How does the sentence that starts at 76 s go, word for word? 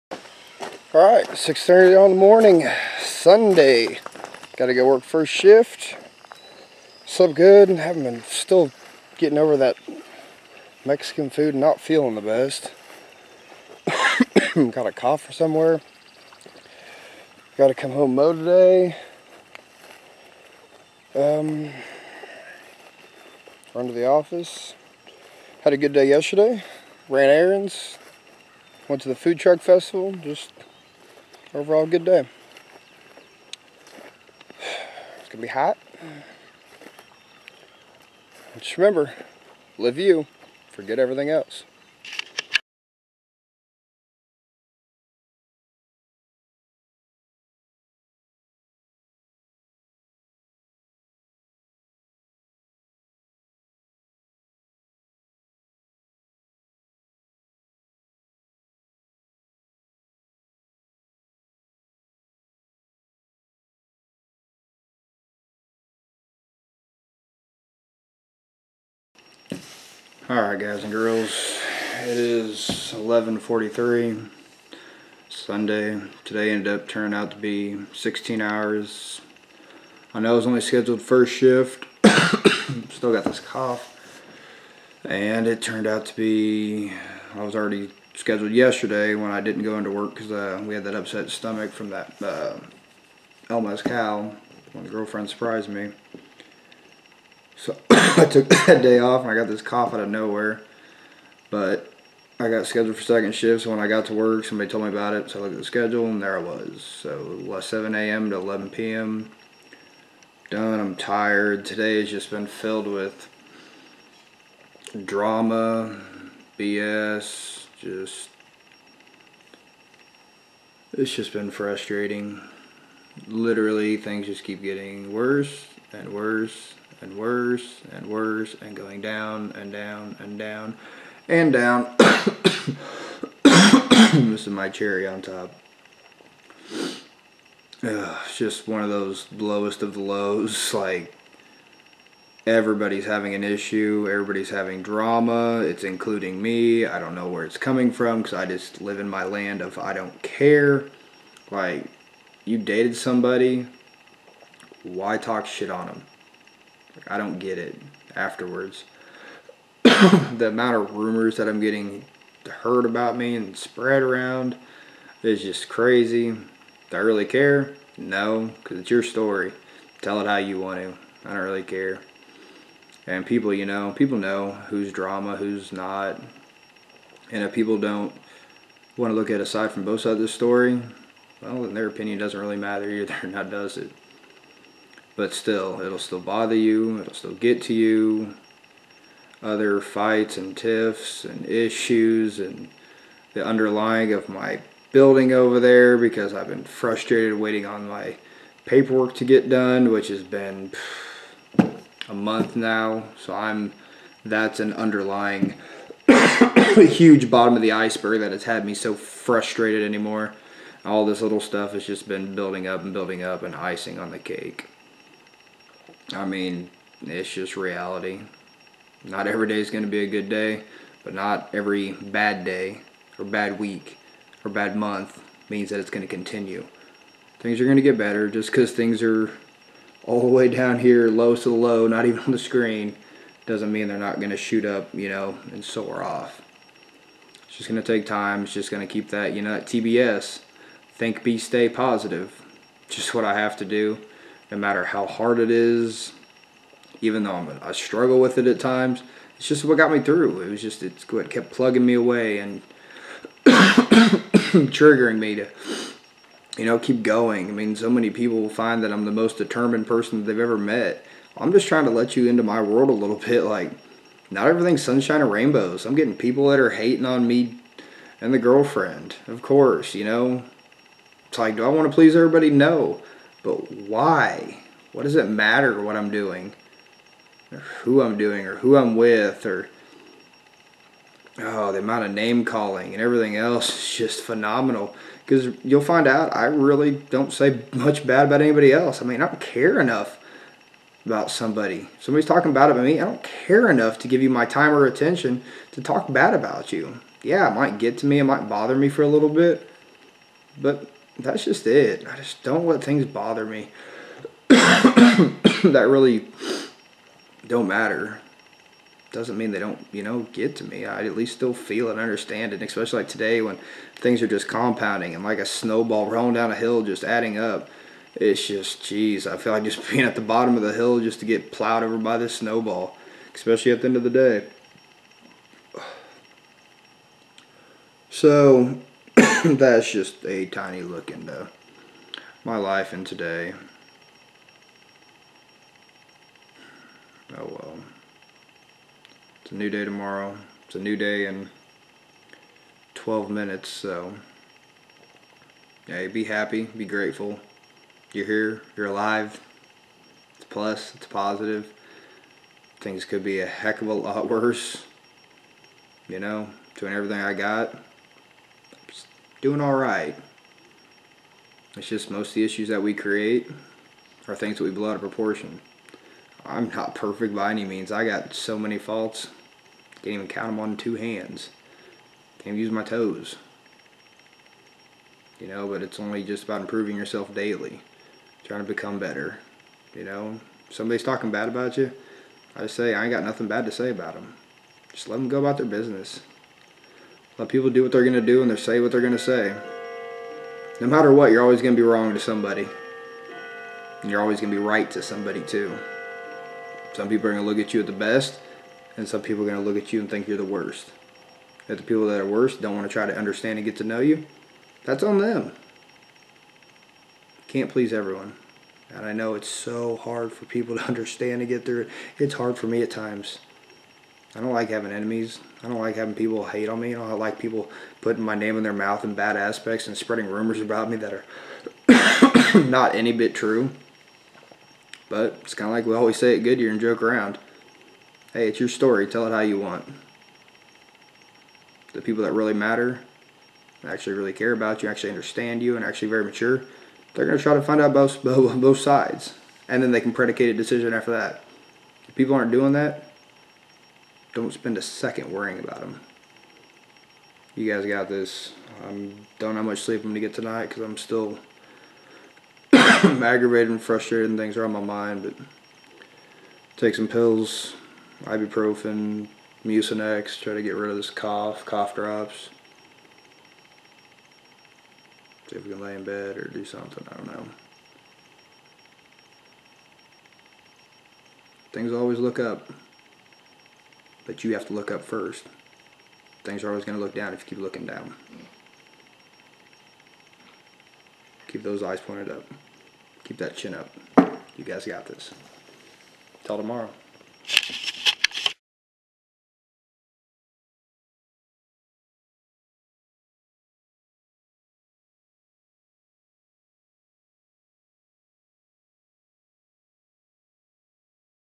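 Today ended up turning out to be 16 hours.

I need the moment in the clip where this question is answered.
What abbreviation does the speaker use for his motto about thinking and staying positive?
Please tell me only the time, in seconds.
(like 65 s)
239 s.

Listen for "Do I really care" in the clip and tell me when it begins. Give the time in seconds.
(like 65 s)
166 s.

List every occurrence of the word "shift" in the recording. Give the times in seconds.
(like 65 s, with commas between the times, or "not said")
5 s, 81 s, 103 s.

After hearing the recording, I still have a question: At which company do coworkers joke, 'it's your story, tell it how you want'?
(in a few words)
Goodyear.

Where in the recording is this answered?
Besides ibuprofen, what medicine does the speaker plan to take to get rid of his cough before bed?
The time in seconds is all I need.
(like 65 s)
459 s.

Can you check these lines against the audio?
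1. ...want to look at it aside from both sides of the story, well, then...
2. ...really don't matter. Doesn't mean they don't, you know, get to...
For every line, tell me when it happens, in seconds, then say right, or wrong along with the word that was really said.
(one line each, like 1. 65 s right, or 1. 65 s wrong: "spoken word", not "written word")
1. 178 s right
2. 305 s right.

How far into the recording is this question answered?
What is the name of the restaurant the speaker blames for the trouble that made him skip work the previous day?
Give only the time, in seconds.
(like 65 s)
93 s.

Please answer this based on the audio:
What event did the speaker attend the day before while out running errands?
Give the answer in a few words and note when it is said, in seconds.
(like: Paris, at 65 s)
food truck festival, at 29 s.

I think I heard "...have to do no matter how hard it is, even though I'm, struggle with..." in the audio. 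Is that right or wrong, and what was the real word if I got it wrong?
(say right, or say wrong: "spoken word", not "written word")
right.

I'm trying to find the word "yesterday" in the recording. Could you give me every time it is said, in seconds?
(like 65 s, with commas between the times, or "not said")
26 s, 88 s.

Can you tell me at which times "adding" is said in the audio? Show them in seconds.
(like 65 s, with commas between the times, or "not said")
317 s.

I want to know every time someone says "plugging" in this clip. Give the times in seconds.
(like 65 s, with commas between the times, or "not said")
251 s.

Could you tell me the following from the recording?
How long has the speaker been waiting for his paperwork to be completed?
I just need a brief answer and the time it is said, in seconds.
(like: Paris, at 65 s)
a month, at 202 s.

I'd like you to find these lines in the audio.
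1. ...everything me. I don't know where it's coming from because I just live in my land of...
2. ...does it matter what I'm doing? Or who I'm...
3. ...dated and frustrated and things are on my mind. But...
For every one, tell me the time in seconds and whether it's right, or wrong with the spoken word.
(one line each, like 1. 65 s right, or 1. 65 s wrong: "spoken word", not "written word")
1. 145 s wrong: "including", not "everything"
2. 275 s right
3. 452 s wrong: "aggravated", not "dated".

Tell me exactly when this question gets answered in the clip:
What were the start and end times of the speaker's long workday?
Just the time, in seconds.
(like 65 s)
107 s.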